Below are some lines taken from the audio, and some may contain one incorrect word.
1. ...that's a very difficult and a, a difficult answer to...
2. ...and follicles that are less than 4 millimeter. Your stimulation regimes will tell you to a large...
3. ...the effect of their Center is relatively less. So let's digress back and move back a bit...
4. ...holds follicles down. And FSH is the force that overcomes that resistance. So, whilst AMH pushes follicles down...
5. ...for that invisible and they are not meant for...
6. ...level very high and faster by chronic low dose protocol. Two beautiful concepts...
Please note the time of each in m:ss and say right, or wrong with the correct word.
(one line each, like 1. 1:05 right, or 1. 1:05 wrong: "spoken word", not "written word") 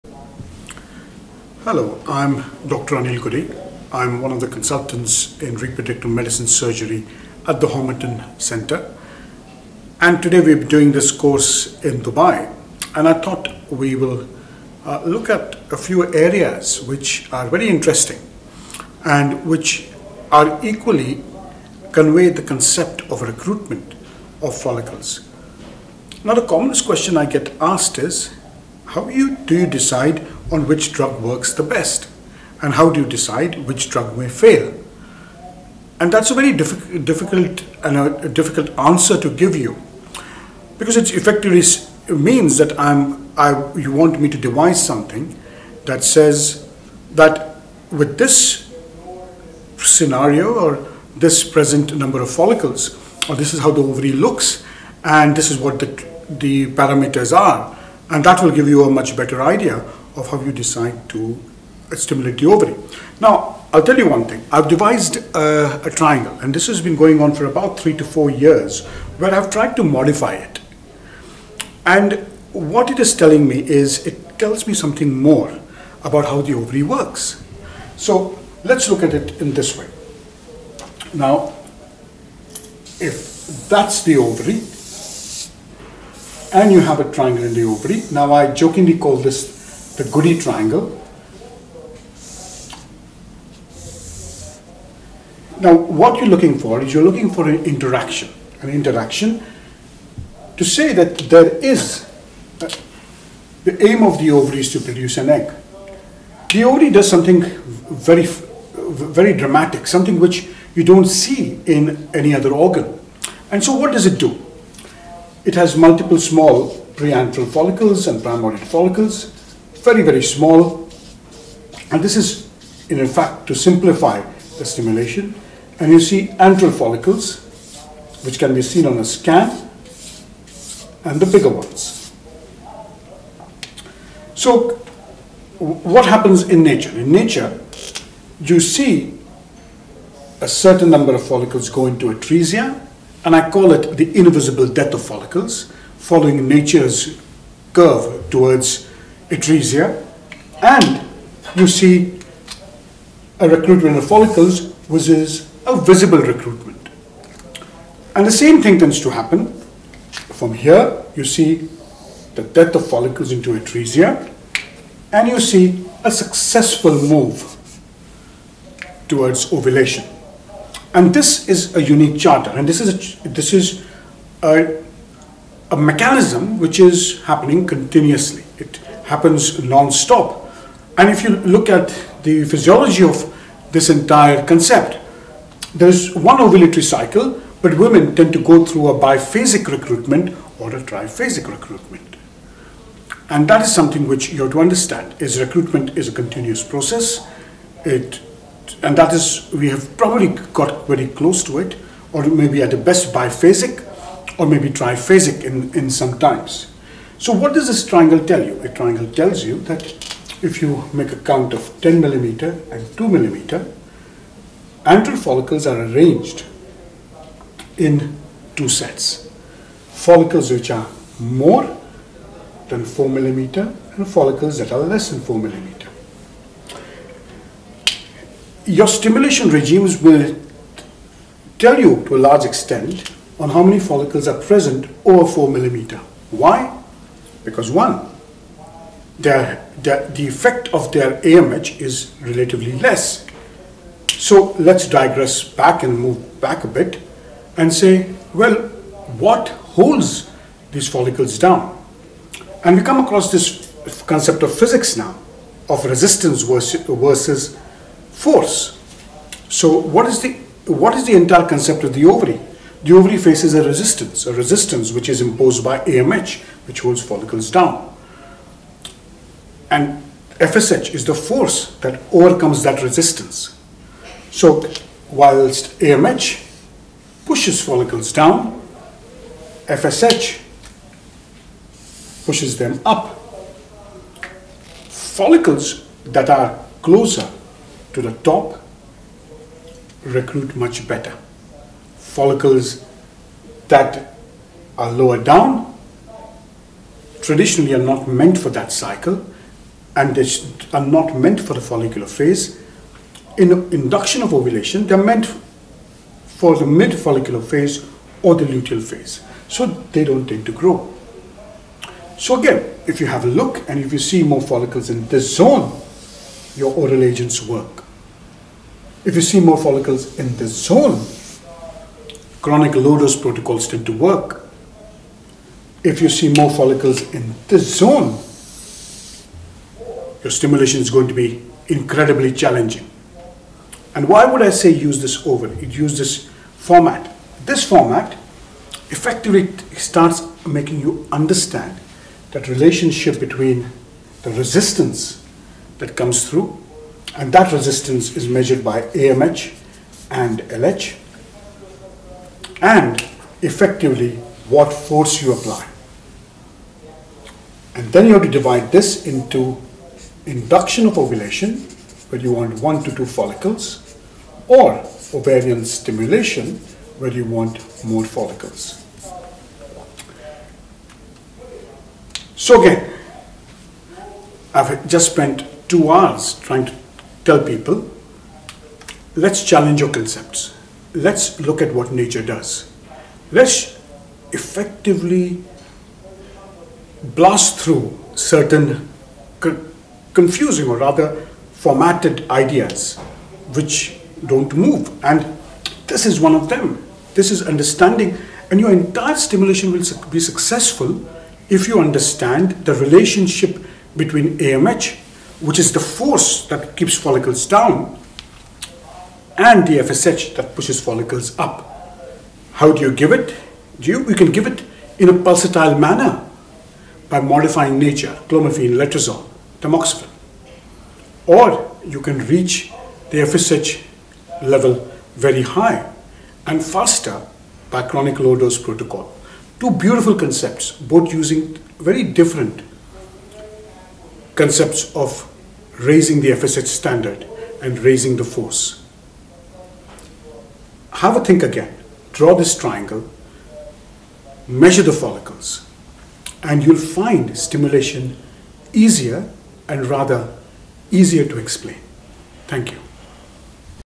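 1. 0:36 right
2. 3:43 right
3. 4:00 wrong: "AMH", not "Center"
4. 4:26 right
5. 4:58 wrong: "cycle", not "invisible"
6. 7:04 right.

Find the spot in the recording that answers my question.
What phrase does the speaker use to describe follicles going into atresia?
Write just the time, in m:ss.
2:24.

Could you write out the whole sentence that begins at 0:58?
And that will give you a much better idea of how you decide to stimulate the ovary.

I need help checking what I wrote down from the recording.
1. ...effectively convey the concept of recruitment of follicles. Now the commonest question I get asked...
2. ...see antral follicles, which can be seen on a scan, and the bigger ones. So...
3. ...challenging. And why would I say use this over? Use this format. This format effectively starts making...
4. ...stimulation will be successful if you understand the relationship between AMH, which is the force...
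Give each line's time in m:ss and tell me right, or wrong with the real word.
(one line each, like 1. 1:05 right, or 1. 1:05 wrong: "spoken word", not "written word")
1. 0:20 wrong: "equally", not "effectively"
2. 2:05 right
3. 5:32 right
4. 6:39 right.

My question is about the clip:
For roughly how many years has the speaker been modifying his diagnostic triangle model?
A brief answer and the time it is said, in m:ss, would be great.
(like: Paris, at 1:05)
3 to 4 years, at 1:07.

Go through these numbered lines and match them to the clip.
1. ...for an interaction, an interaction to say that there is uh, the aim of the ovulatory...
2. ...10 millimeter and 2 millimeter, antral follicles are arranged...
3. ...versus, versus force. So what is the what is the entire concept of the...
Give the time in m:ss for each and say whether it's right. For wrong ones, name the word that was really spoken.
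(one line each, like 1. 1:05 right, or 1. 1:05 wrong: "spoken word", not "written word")
1. 1:37 wrong: "ovary", not "ovulatory"
2. 3:31 right
3. 4:16 right.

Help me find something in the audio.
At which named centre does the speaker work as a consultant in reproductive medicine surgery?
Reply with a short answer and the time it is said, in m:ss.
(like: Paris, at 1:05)
Homerton Center, at 0:07.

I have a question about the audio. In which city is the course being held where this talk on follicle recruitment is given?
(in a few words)
Dubai.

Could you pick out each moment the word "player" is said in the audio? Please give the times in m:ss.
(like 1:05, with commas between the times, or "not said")
not said.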